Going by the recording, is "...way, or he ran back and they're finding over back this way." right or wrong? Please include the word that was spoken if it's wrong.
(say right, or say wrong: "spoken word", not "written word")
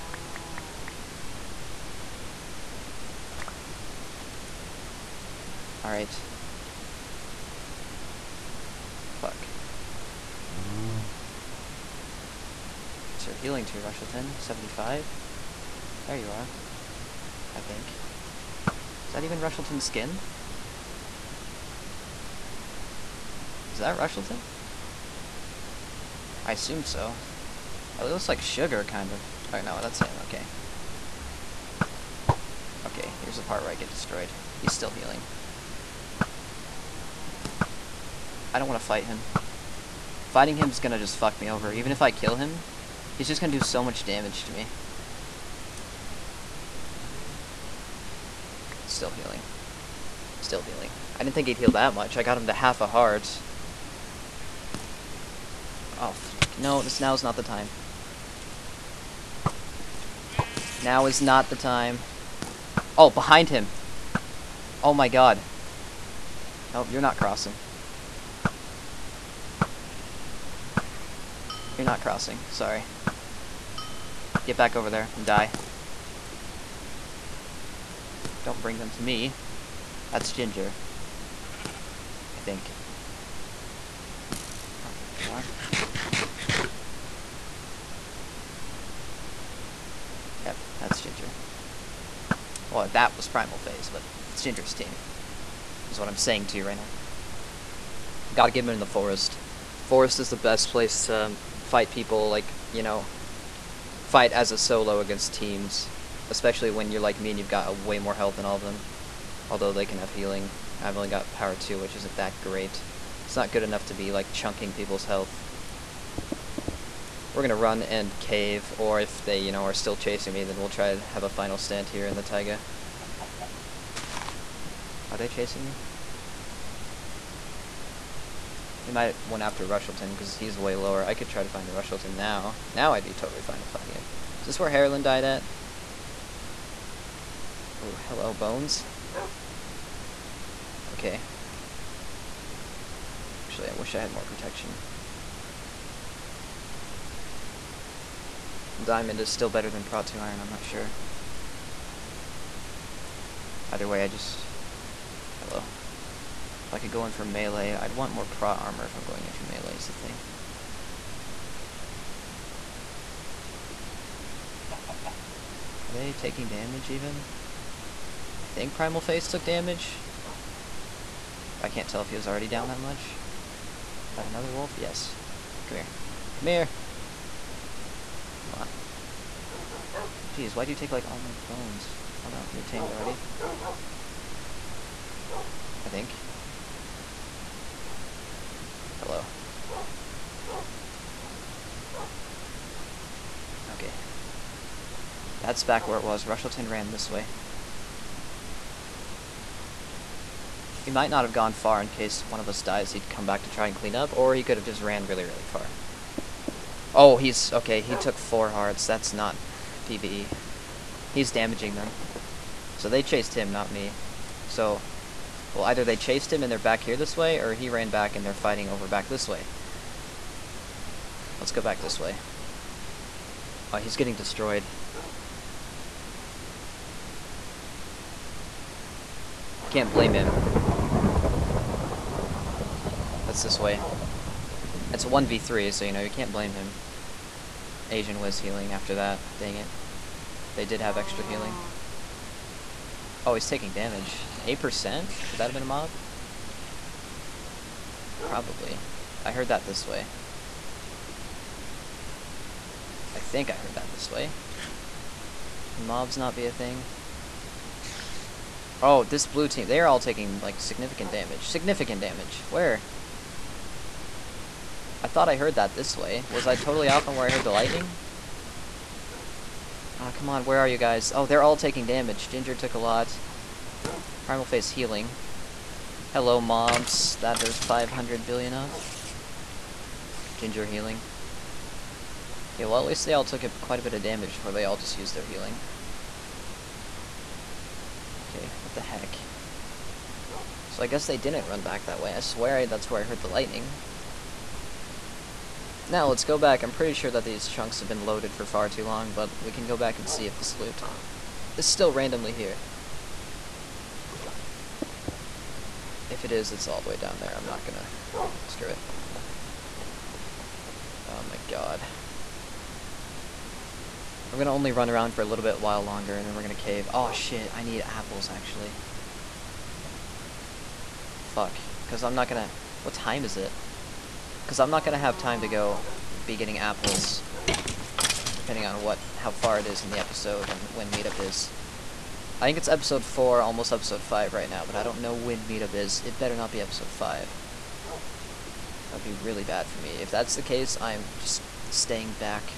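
wrong: "fighting", not "finding".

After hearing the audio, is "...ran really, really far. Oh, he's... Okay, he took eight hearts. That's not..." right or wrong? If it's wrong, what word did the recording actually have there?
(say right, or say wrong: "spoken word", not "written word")
wrong: "four", not "eight".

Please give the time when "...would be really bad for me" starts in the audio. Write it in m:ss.
5:38.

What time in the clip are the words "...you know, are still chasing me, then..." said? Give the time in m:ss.
1:59.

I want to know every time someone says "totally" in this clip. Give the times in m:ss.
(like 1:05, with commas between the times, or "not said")
2:13, 4:26.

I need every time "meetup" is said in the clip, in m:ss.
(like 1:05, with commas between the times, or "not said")
5:30, 5:35.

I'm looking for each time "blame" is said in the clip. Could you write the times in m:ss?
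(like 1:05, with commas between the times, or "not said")
3:49, 3:56.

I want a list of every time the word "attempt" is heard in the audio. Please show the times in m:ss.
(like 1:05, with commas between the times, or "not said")
not said.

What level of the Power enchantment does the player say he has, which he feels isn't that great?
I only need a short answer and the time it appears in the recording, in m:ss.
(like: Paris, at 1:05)
2, at 1:51.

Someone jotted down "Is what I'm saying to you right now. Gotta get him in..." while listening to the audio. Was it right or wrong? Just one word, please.
right.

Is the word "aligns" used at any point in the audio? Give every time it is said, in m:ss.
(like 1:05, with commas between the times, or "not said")
not said.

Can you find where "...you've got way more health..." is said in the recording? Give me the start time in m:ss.
1:47.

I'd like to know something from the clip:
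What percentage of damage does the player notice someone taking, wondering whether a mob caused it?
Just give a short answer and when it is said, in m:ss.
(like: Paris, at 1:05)
8%, at 4:04.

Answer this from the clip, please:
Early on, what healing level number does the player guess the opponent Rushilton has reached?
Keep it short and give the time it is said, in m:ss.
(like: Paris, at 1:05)
75, at 0:14.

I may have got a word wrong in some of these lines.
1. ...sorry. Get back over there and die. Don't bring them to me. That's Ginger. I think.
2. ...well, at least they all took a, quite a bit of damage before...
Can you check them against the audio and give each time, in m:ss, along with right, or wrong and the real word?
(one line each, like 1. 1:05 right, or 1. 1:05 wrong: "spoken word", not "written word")
1. 1:12 right
2. 4:42 right.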